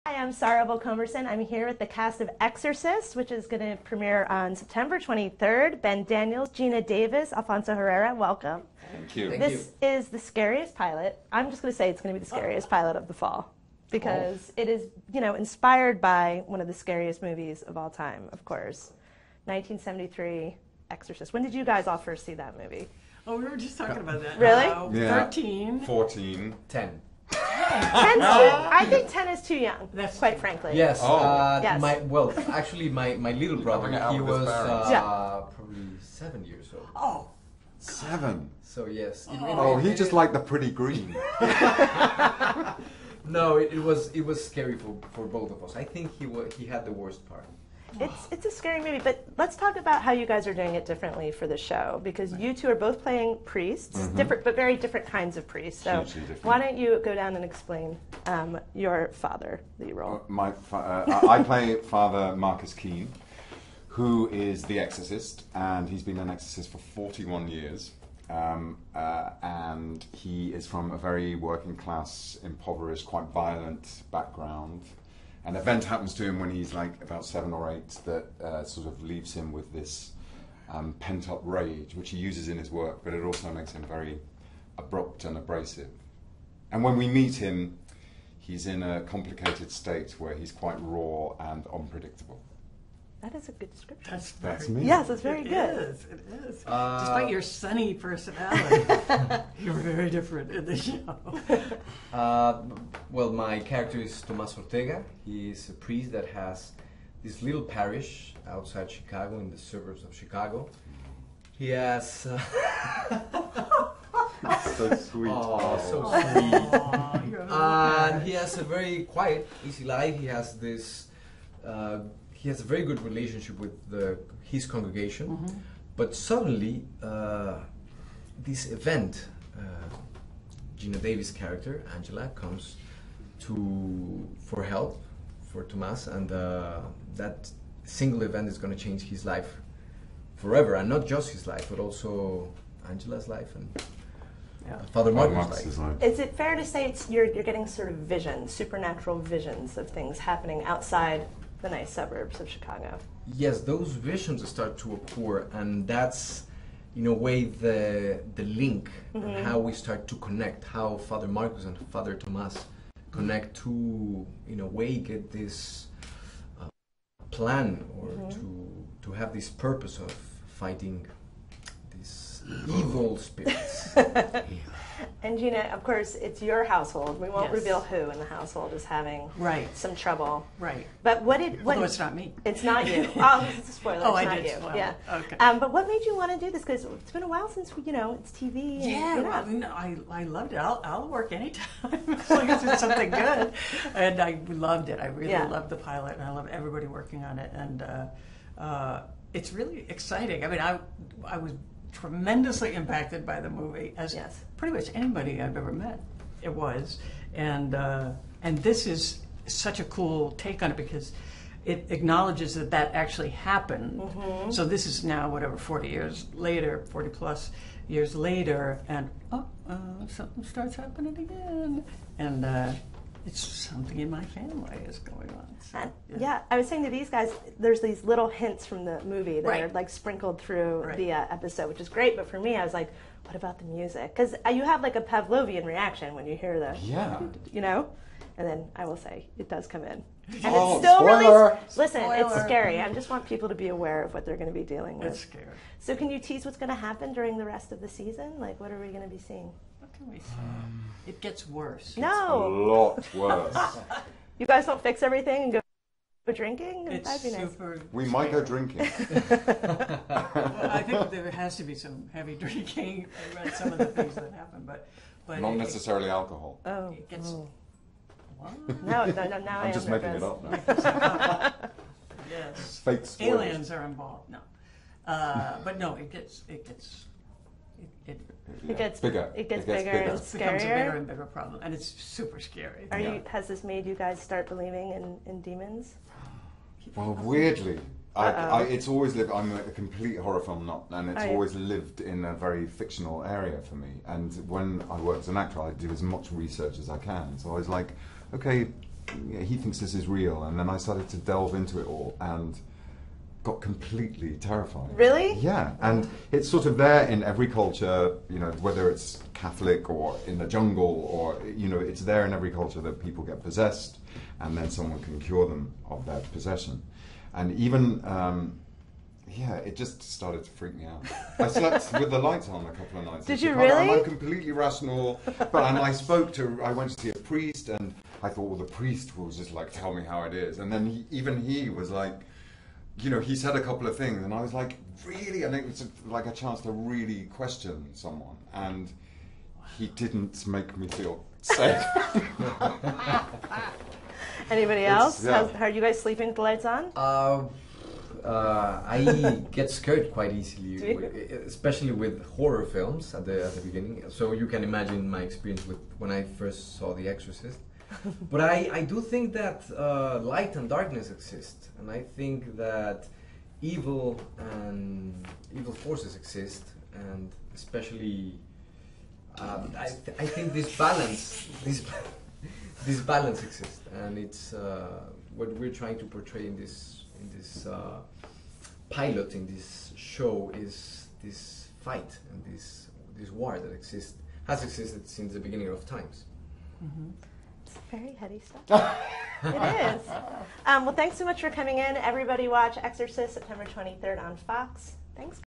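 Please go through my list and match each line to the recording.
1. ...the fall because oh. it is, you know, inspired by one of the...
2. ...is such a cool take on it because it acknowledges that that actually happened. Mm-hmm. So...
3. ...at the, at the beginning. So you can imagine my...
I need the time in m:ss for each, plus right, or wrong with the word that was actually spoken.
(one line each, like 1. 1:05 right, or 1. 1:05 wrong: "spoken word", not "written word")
1. 0:13 right
2. 3:28 right
3. 5:53 right.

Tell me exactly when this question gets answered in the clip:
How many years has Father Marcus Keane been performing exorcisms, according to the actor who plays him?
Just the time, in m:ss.
1:06.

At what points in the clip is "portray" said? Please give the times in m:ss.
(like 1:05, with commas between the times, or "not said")
6:16.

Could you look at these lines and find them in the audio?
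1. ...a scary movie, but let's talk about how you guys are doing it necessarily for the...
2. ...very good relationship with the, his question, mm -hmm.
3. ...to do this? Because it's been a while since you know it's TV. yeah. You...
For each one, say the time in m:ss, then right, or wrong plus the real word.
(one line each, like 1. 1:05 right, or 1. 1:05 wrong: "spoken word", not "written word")
1. 0:48 wrong: "differently", not "necessarily"
2. 2:02 wrong: "congregation", not "question"
3. 3:06 right.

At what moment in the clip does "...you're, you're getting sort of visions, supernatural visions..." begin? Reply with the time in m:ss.
2:27.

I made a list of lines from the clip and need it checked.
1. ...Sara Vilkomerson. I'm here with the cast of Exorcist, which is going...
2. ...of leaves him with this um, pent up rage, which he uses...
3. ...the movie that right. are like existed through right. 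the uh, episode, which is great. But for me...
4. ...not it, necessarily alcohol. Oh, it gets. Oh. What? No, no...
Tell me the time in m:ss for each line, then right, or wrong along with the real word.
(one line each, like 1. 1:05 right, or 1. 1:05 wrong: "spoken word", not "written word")
1. 0:00 right
2. 1:18 right
3. 3:48 wrong: "sprinkled", not "existed"
4. 4:25 right.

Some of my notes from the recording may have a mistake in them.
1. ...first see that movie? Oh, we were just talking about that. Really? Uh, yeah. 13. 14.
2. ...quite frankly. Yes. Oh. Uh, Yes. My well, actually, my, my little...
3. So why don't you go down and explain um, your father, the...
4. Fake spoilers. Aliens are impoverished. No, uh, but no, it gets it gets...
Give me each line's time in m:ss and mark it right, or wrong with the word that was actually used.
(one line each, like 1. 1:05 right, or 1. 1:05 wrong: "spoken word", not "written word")
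1. 0:21 right
2. 0:30 right
3. 0:55 right
4. 4:32 wrong: "involved", not "impoverished".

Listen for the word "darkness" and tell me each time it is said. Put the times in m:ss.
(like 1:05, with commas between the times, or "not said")
6:00.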